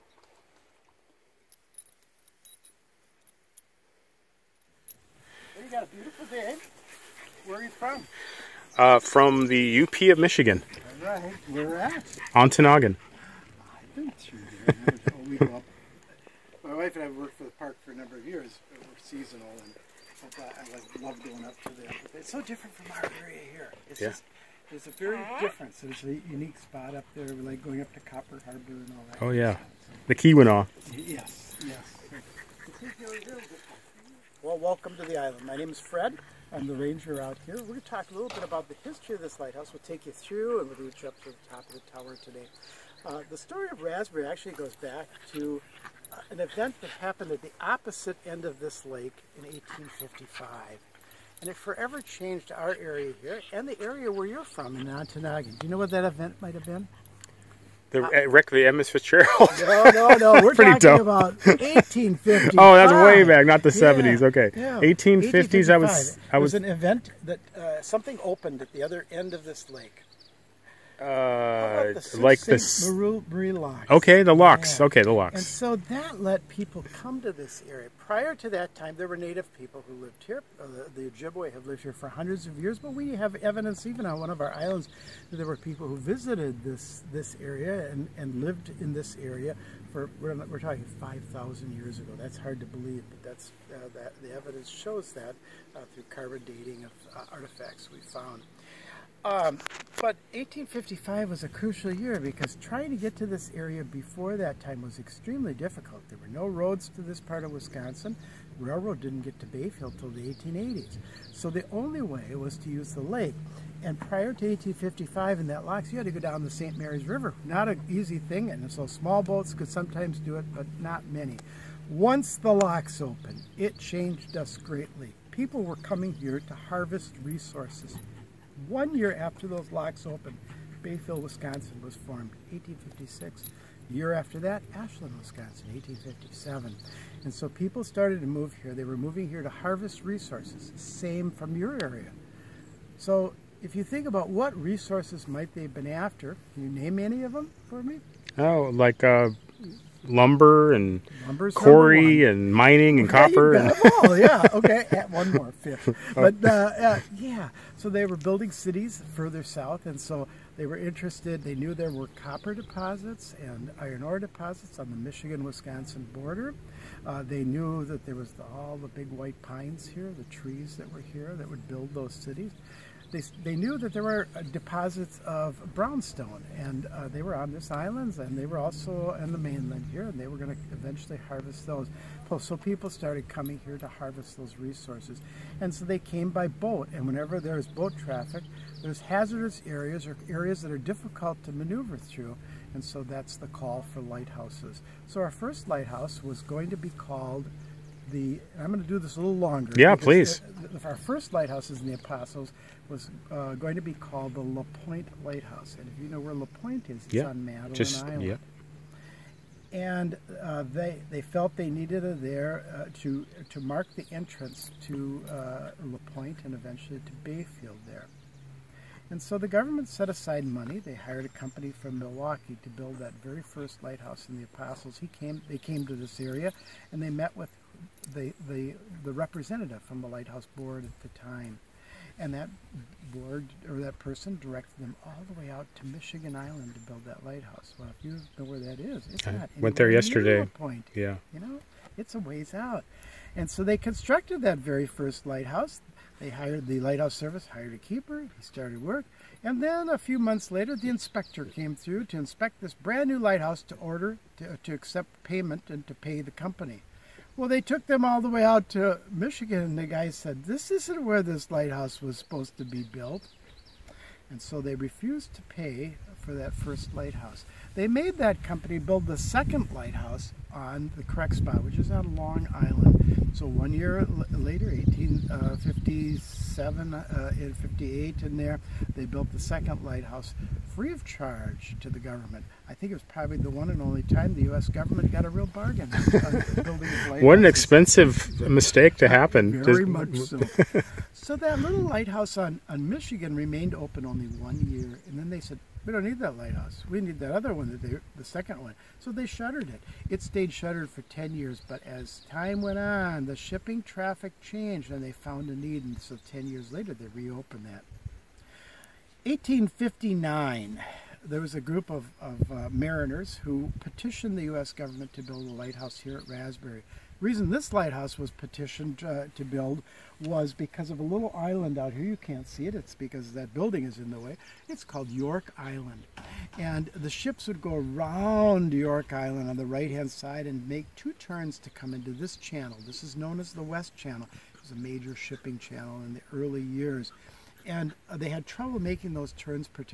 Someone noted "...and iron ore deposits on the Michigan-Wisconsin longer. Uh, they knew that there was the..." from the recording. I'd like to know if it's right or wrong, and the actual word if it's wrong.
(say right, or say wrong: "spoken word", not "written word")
wrong: "border", not "longer".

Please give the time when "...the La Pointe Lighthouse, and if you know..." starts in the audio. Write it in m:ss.
3:24.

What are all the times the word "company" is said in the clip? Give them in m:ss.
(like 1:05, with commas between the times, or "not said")
3:41, 4:16, 4:28.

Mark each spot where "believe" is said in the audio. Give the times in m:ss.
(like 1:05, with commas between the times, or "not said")
1:32.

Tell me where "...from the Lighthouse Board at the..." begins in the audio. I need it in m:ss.
3:49.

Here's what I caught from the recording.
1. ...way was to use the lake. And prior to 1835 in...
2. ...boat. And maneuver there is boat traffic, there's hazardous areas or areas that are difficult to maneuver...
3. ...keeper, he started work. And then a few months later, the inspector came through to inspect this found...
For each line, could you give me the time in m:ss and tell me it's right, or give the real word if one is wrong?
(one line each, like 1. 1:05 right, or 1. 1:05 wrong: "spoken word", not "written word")
1. 1:52 wrong: "1855", not "1835"
2. 3:06 wrong: "whenever", not "maneuver"
3. 4:07 wrong: "brand", not "found".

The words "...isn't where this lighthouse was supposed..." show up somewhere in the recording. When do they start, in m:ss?
4:20.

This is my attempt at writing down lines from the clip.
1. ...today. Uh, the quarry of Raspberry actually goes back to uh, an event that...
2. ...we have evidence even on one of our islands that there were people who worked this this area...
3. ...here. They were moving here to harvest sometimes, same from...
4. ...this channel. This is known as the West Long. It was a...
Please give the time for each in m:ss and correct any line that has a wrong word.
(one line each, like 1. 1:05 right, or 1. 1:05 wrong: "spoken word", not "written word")
1. 0:42 wrong: "story", not "quarry"
2. 1:22 wrong: "visited", not "worked"
3. 2:18 wrong: "resources", not "sometimes"
4. 5:32 wrong: "Channel", not "Long".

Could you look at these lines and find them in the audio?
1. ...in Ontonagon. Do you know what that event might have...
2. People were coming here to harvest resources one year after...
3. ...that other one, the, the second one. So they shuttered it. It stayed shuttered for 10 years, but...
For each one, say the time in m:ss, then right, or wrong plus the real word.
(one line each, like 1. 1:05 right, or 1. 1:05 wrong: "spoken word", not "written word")
1. 0:54 right
2. 2:05 right
3. 4:57 right.